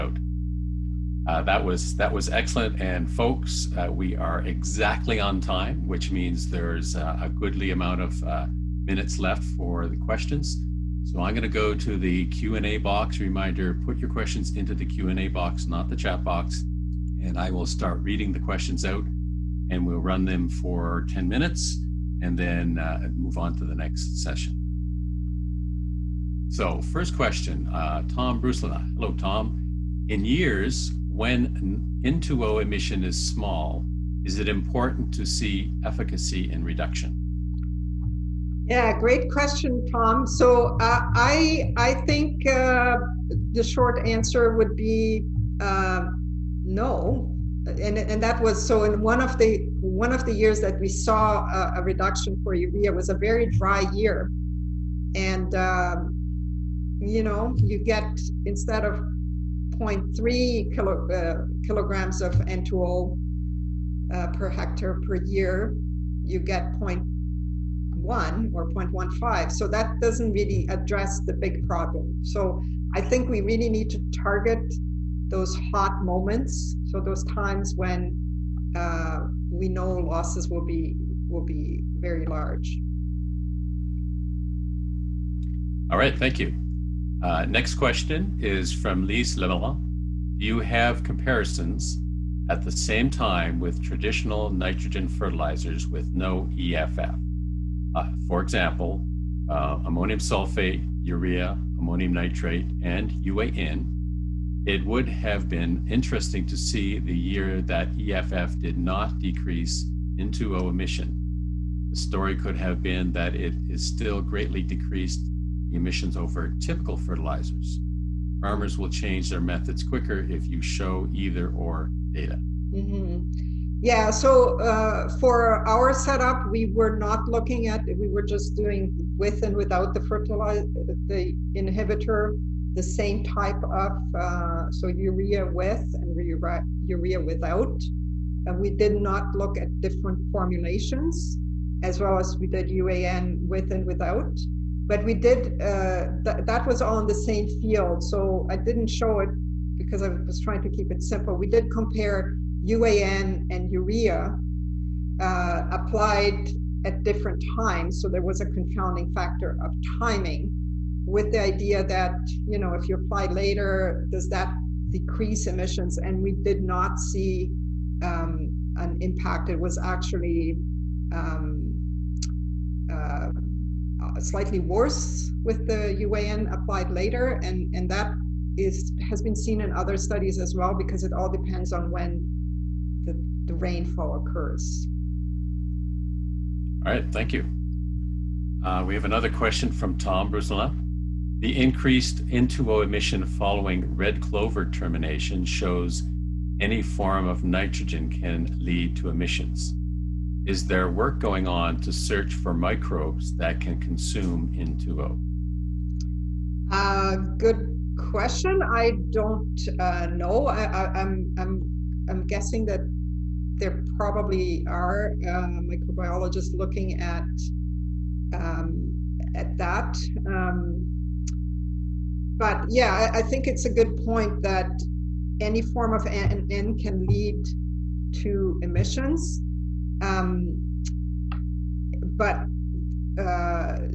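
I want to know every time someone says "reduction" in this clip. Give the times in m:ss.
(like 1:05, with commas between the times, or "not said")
0:36, 0:51.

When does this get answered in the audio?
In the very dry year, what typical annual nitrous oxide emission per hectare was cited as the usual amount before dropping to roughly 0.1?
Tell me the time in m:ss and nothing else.
0:59.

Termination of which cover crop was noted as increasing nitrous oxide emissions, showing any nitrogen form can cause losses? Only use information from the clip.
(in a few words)
red clover.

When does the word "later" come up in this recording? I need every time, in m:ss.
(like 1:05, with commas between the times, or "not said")
2:43, 2:56.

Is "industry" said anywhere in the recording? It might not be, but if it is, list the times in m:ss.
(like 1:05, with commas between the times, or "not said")
not said.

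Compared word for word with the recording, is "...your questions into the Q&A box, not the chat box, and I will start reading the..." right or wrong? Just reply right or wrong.
right.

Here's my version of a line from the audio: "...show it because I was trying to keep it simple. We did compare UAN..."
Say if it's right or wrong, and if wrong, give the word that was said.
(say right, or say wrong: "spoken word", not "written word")
right.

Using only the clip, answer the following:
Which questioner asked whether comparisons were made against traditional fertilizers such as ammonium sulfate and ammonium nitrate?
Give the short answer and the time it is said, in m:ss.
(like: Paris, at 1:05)
Lise Lemelin, at 1:29.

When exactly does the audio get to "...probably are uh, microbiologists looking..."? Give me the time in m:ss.
3:33.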